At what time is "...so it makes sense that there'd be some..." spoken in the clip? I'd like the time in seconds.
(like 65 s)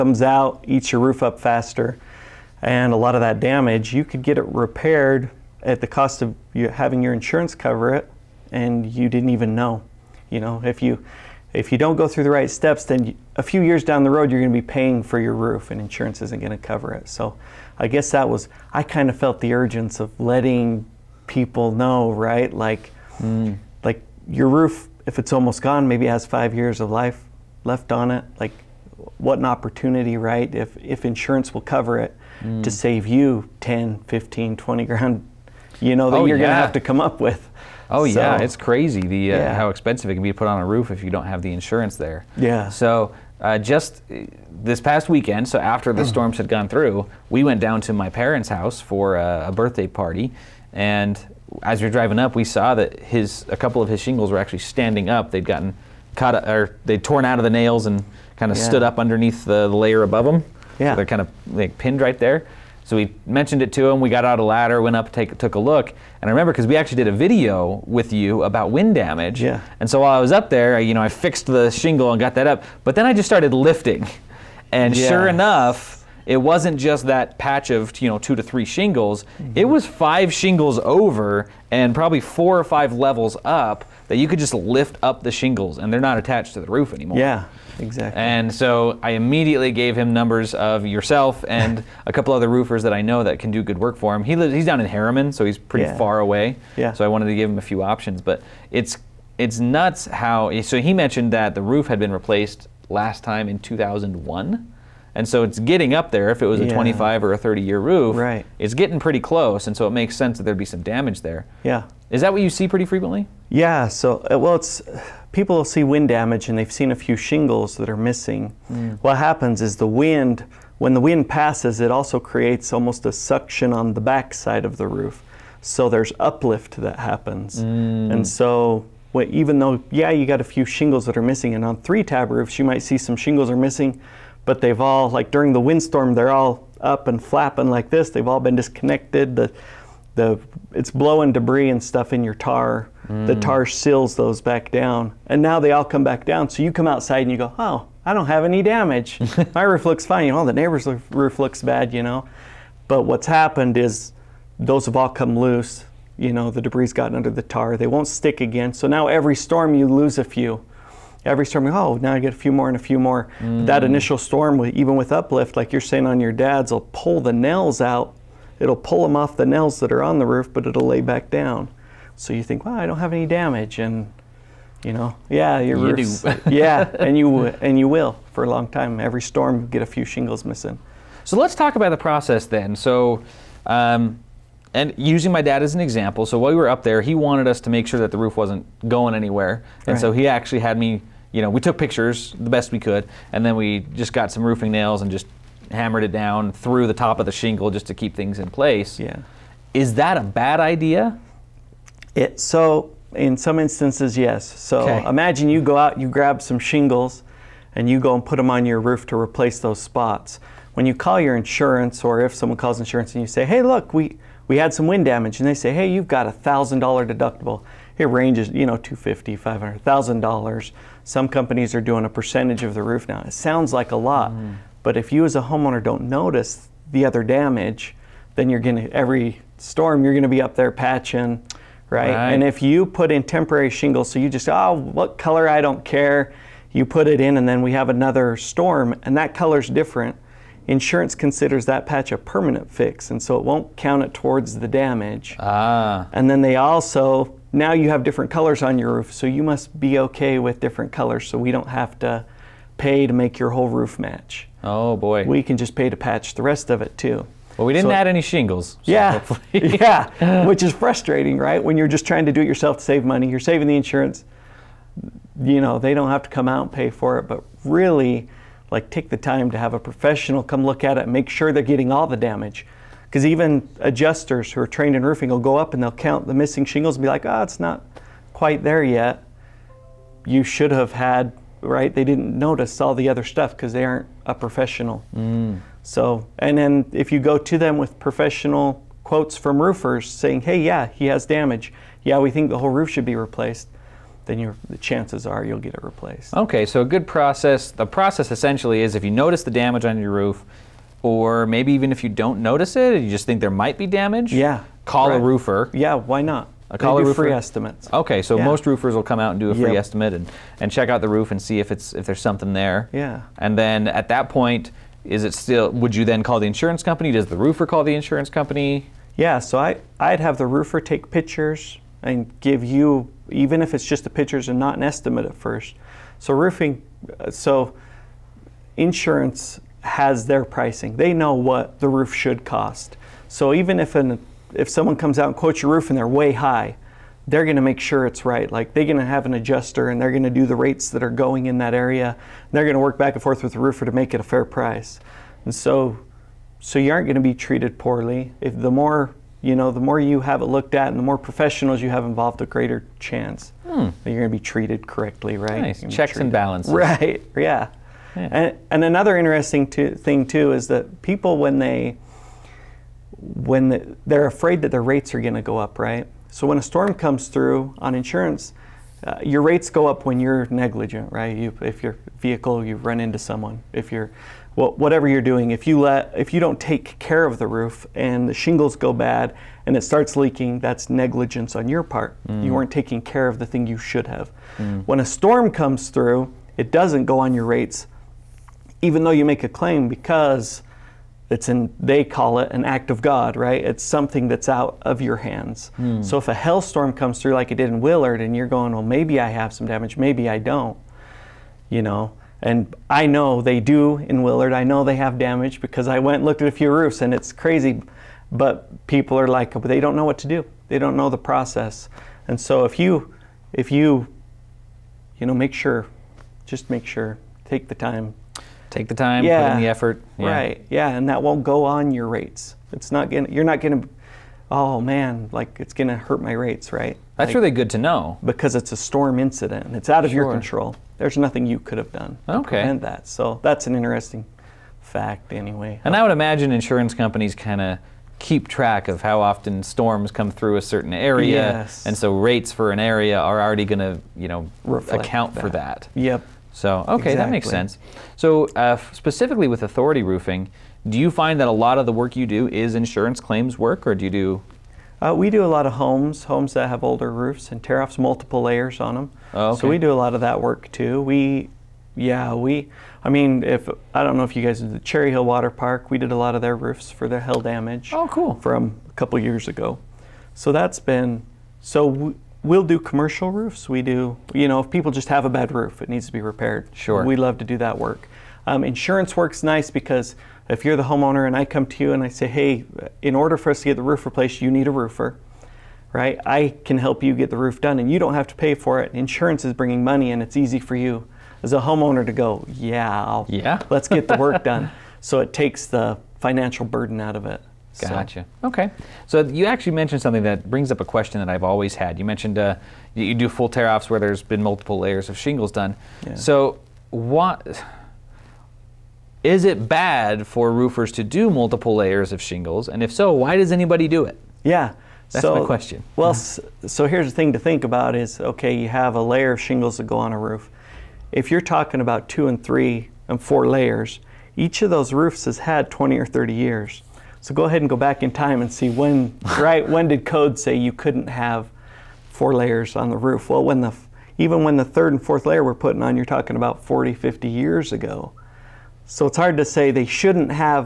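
109 s.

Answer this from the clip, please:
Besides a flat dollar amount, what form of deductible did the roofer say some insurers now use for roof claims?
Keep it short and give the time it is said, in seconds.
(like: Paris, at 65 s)
A percentage of the roof, at 222 s.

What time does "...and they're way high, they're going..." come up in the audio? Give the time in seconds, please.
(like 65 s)
335 s.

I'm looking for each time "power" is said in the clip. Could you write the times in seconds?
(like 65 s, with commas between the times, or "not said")
not said.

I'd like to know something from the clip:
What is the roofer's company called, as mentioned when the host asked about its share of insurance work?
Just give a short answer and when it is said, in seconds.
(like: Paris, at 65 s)
Authority Roofing, at 449 s.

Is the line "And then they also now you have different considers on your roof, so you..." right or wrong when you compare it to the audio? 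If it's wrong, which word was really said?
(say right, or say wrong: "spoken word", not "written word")
wrong: "colors", not "considers".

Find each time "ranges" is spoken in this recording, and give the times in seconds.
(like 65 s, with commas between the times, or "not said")
218 s.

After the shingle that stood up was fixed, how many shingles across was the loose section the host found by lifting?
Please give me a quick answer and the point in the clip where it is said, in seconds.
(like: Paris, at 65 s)
5, at 79 s.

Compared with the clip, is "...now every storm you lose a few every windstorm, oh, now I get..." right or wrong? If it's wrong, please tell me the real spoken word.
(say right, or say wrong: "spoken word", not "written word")
wrong: "storm", not "windstorm".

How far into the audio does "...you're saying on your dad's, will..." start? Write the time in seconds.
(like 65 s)
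165 s.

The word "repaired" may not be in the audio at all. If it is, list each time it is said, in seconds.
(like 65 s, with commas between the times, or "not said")
4 s, 476 s.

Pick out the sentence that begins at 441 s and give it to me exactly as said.
and so rates for an area are already going to you know Reflect account that.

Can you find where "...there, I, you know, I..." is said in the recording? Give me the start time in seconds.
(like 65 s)
70 s.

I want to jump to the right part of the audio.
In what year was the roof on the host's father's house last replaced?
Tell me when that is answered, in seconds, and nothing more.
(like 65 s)
103 s.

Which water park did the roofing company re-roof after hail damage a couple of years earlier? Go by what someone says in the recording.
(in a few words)
Cherry Hill Water Park.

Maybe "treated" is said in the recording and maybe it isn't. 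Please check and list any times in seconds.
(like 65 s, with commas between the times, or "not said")
347 s, 354 s.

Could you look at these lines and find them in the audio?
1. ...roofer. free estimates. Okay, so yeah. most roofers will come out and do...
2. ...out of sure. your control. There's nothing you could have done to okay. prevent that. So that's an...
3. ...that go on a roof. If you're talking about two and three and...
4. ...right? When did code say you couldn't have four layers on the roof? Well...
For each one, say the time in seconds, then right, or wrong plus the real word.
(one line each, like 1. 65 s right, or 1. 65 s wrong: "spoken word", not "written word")
1. 307 s right
2. 429 s right
3. 519 s right
4. 529 s right.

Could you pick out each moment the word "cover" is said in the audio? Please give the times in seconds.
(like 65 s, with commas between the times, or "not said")
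7 s, 16 s, 31 s.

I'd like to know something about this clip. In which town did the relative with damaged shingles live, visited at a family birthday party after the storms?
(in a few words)
Herriman.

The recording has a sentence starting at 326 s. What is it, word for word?
So roofing, uh, so insurance has their pricing.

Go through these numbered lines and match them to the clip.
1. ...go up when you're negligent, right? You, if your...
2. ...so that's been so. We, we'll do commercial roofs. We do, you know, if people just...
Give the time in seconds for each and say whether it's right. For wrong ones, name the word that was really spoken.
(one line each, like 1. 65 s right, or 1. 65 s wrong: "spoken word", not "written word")
1. 369 s right
2. 470 s right.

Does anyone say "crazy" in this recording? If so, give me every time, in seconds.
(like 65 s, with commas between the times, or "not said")
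38 s, 407 s.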